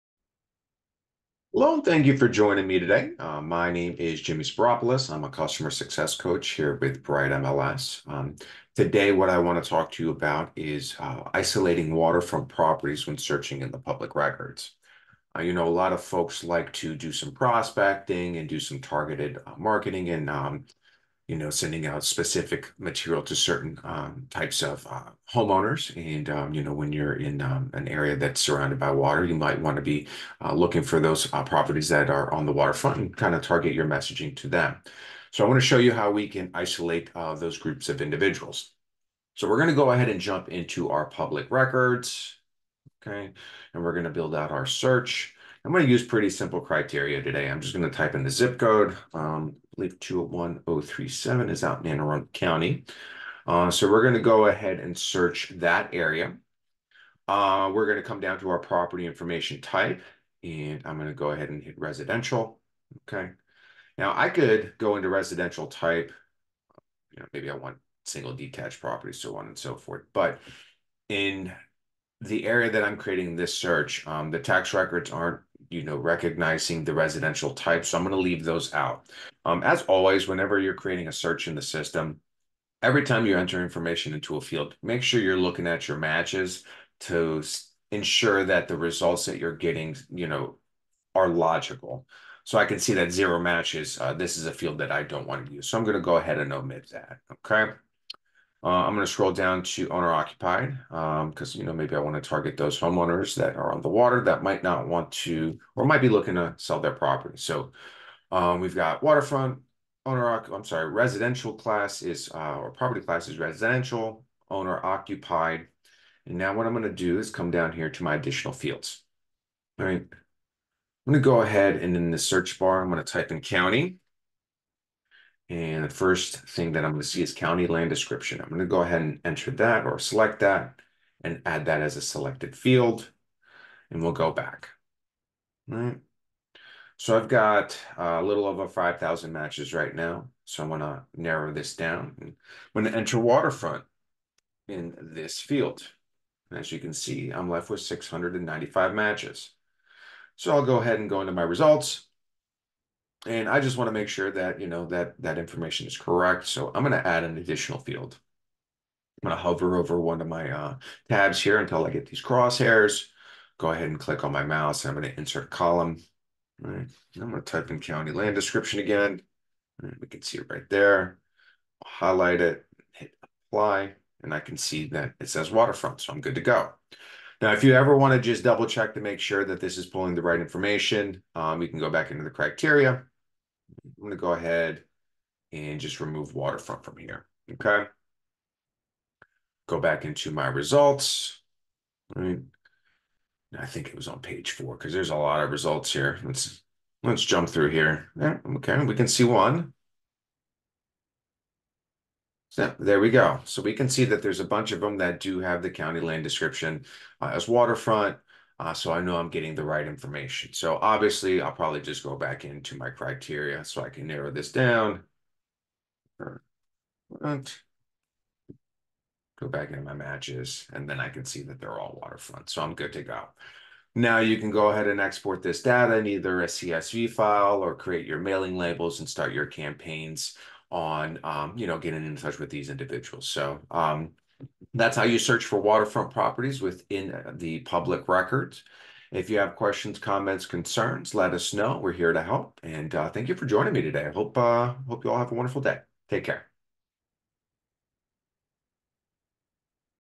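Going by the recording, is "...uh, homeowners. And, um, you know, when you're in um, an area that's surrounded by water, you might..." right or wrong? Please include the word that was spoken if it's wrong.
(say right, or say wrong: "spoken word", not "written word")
right.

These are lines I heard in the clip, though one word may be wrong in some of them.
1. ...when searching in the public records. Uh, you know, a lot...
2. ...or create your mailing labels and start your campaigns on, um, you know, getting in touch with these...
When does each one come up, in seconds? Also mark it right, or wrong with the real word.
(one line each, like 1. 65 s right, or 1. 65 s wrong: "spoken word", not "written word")
1. 13 s right
2. 227 s right.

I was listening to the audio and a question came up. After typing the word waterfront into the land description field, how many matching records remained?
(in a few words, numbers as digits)
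695.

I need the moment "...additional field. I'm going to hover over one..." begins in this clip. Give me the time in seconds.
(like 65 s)
157 s.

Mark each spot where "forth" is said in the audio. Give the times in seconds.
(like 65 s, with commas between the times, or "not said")
69 s.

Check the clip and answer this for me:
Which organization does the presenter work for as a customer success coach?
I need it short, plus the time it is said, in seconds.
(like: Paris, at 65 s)
Bright MLS, at 7 s.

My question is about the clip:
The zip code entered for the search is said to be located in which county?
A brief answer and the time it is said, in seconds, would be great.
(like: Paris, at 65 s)
Anne Arundel County, at 51 s.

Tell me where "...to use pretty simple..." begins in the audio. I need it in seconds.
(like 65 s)
45 s.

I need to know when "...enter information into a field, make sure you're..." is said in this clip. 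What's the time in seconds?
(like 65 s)
83 s.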